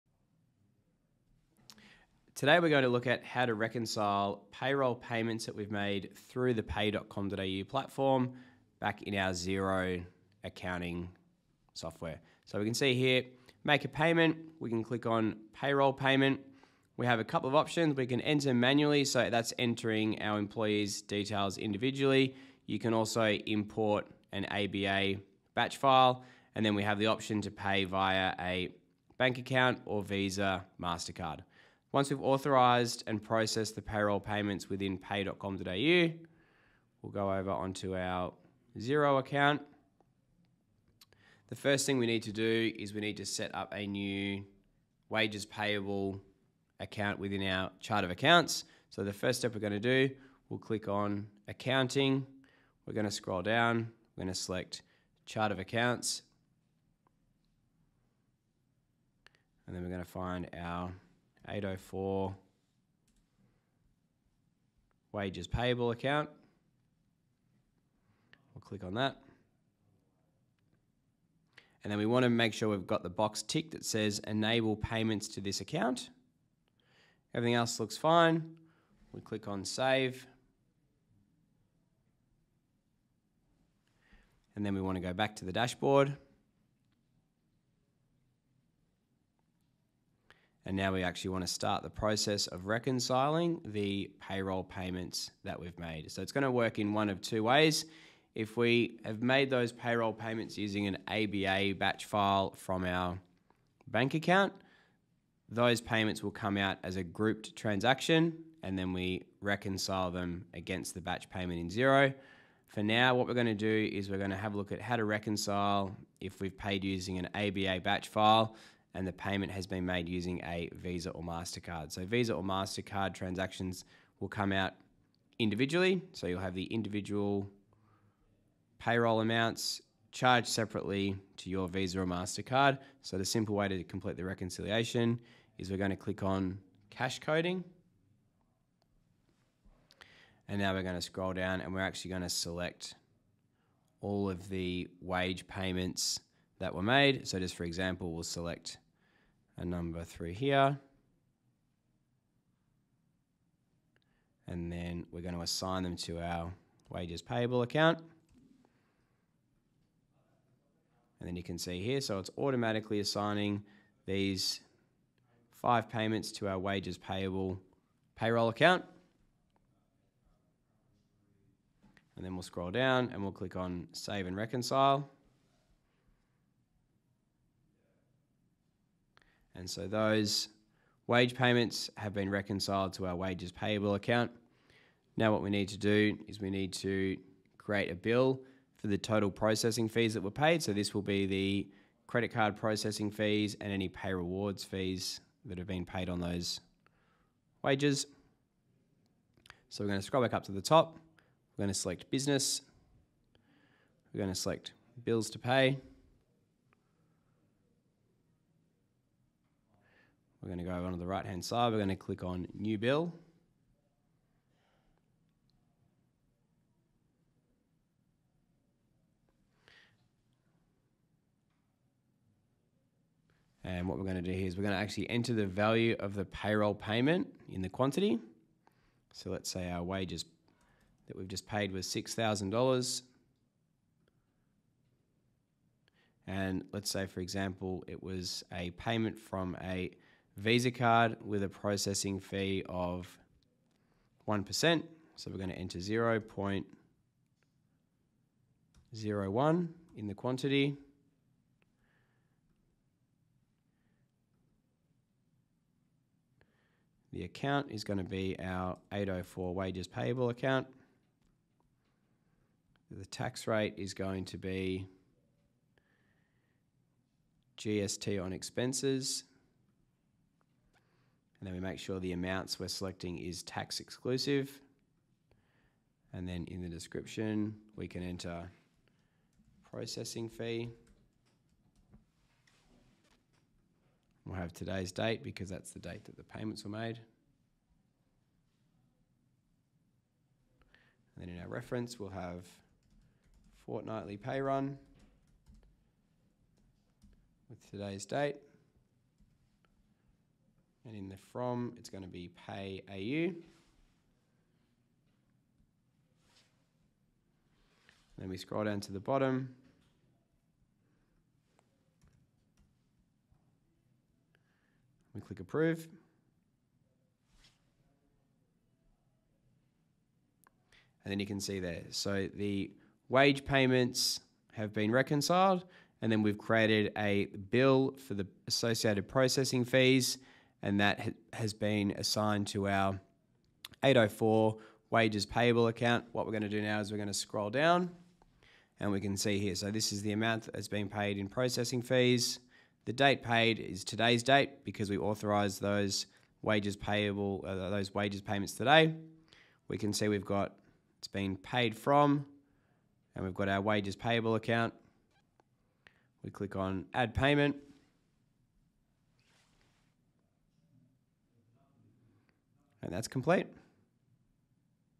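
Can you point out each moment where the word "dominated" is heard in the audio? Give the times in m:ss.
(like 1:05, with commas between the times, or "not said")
not said.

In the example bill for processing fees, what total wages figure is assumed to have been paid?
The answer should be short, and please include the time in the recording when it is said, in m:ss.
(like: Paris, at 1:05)
$6,000, at 3:51.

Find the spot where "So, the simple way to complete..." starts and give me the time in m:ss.
2:13.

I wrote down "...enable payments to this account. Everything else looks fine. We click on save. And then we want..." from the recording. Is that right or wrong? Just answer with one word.
right.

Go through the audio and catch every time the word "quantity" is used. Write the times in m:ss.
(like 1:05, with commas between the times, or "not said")
3:47, 4:10.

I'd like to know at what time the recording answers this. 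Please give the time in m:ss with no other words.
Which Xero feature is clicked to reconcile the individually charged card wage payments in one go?
2:16.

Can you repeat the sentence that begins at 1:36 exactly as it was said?
So it's going to work in one of two ways.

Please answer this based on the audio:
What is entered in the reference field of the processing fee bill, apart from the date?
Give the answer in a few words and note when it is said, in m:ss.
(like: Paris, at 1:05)
fortnightly pay run, at 4:53.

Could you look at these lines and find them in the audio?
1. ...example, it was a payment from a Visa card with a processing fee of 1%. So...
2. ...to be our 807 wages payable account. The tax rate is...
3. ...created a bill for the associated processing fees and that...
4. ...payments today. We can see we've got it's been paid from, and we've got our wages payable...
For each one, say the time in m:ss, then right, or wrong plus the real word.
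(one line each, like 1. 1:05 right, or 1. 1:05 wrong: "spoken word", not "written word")
1. 3:57 right
2. 4:17 wrong: "804", not "807"
3. 5:26 right
4. 5:48 right.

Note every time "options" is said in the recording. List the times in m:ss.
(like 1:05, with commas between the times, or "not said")
0:17, 0:27.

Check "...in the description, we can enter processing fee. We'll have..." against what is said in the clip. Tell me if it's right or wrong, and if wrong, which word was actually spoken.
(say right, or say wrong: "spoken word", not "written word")
right.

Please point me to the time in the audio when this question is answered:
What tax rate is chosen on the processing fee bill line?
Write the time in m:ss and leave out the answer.
4:27.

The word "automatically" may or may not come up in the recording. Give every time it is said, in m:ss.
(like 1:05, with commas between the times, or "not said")
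2:42.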